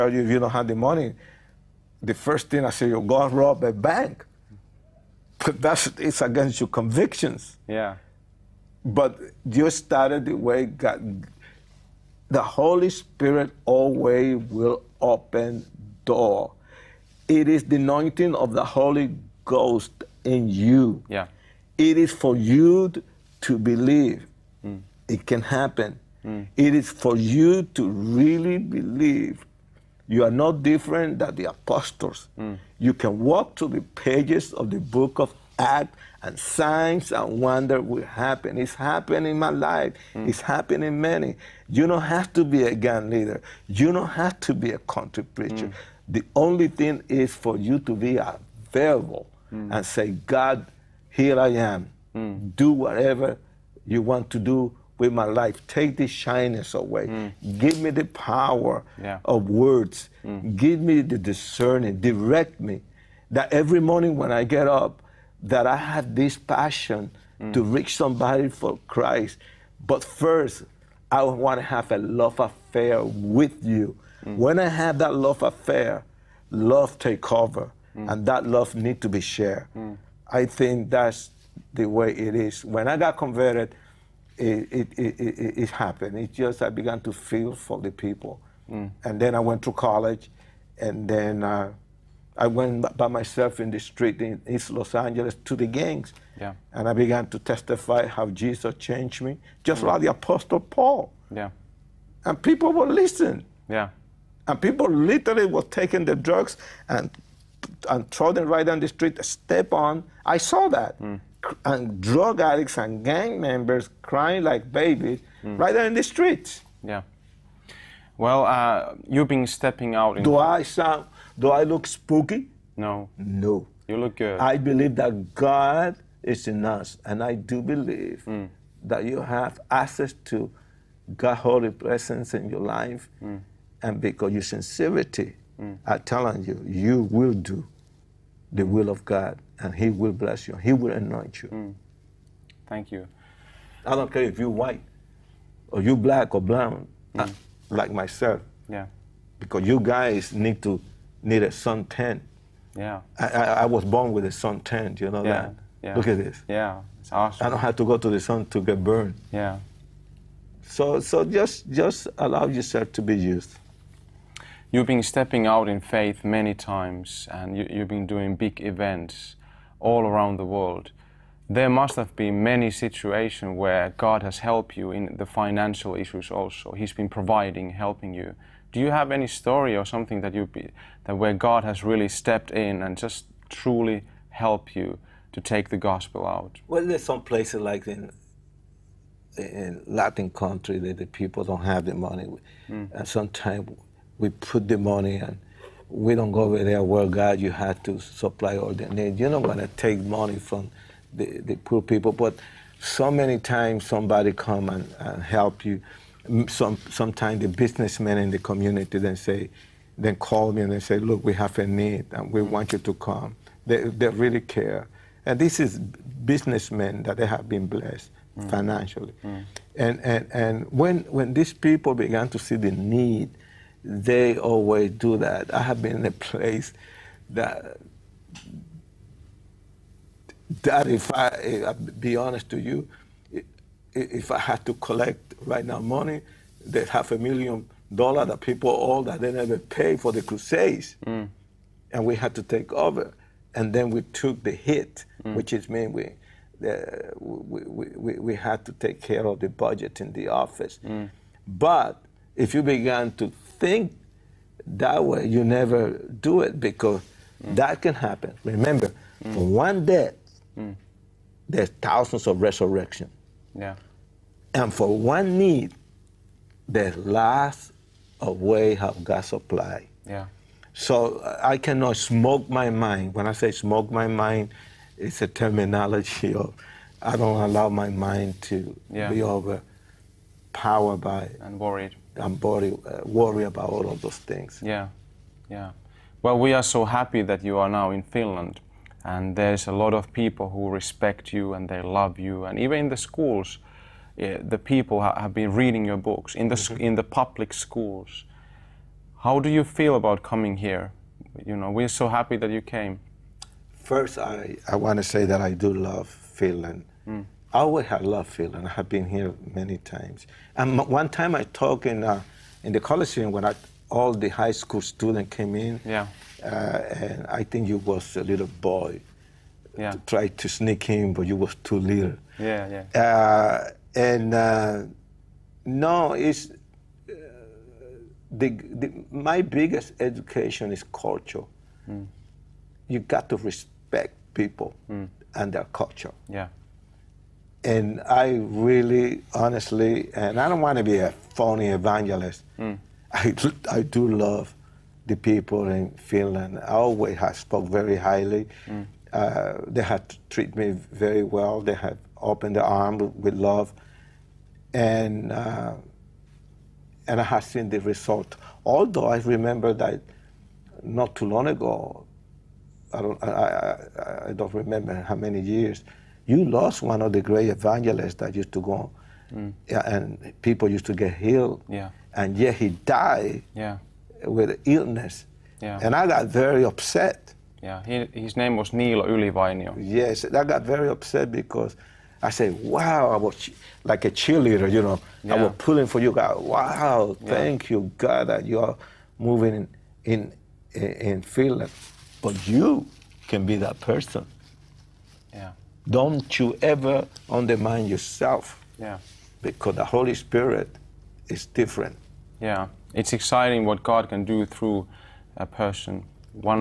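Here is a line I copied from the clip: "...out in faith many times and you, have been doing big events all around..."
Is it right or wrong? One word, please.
right.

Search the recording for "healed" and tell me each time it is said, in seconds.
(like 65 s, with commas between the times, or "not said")
371 s.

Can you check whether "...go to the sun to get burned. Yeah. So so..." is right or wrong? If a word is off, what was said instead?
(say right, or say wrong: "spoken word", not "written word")
right.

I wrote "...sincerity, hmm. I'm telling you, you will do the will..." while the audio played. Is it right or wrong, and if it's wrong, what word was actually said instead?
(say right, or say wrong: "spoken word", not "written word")
right.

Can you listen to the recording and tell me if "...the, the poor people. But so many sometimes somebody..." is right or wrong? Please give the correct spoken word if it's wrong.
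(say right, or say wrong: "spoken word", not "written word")
wrong: "times", not "sometimes".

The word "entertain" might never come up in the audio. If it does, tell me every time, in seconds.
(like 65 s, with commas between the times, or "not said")
not said.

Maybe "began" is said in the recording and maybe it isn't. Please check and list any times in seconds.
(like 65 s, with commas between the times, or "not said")
86 s, 96 s, 221 s, 252 s.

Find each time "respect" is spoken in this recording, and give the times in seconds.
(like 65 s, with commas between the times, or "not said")
290 s, 333 s.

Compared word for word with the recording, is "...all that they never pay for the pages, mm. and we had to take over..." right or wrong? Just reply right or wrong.
wrong.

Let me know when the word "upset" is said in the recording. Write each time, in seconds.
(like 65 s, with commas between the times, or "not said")
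376 s, 380 s.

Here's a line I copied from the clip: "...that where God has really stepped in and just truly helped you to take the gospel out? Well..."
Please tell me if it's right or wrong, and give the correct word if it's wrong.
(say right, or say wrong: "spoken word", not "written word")
right.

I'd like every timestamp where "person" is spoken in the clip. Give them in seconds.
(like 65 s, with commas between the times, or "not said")
393 s, 405 s.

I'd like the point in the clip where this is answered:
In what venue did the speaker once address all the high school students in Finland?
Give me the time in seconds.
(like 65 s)
312 s.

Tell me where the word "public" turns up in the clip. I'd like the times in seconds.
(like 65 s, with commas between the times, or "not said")
297 s.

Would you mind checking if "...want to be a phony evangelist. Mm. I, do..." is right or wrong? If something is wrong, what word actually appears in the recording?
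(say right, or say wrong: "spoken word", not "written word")
right.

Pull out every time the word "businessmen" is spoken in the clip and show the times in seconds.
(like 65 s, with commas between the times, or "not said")
207 s, 215 s.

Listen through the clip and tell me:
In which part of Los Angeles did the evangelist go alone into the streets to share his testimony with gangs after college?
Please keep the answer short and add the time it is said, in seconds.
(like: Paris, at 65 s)
East Los Angeles, at 94 s.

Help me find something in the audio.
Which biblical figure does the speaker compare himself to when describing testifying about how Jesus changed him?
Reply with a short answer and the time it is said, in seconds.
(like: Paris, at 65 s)
the Apostle Paul, at 100 s.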